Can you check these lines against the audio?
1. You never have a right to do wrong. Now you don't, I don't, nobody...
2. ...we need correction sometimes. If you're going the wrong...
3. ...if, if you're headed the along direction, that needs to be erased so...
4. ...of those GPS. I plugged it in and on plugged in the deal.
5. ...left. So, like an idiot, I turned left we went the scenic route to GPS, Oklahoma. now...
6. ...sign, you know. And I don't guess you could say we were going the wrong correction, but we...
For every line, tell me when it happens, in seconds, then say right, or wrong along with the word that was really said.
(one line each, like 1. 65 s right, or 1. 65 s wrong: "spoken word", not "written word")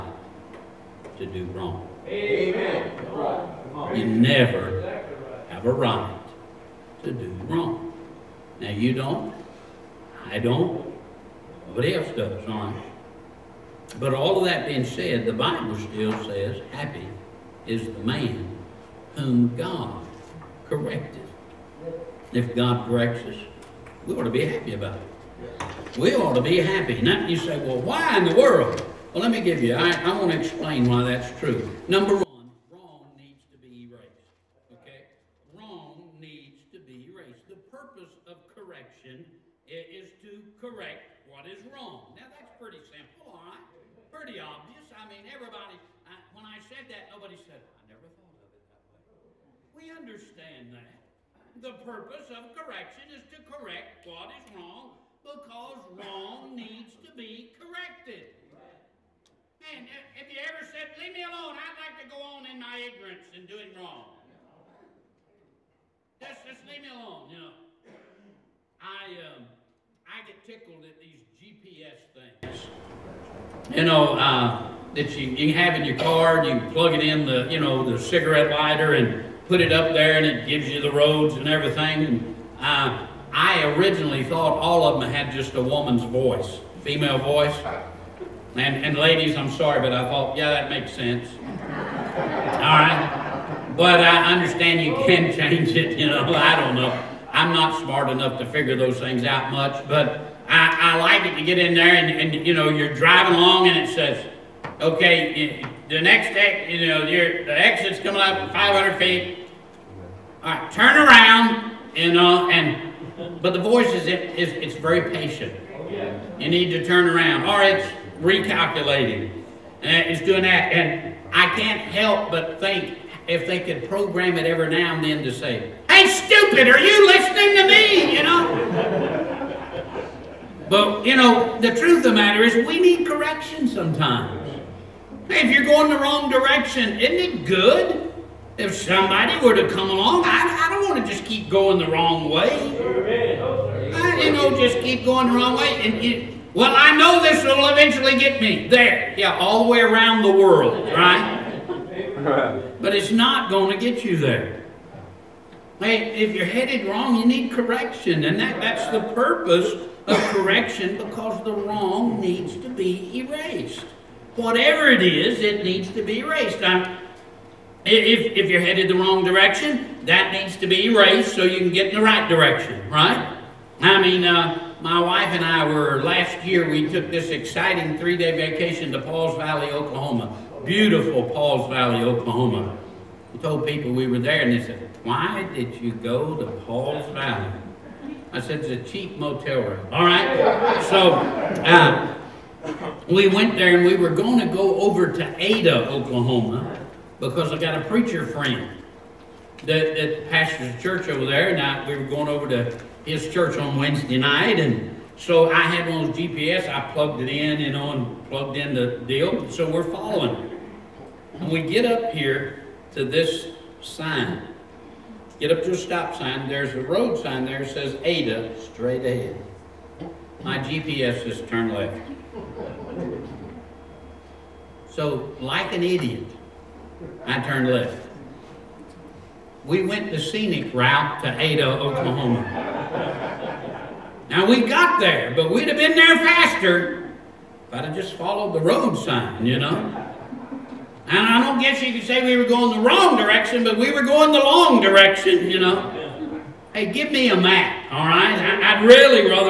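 1. 3 s right
2. 132 s right
3. 167 s wrong: "wrong", not "along"
4. 206 s right
5. 221 s wrong: "Ada", not "GPS"
6. 238 s wrong: "direction", not "correction".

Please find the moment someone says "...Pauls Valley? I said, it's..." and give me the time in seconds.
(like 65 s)
186 s.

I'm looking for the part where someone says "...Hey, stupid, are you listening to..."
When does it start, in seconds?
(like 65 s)
125 s.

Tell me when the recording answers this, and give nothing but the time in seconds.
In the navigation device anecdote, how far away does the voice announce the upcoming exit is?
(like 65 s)
108 s.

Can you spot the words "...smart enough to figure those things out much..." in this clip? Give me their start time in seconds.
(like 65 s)
97 s.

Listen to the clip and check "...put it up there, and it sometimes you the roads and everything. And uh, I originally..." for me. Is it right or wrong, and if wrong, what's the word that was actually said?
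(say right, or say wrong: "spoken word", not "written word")
wrong: "gives", not "sometimes".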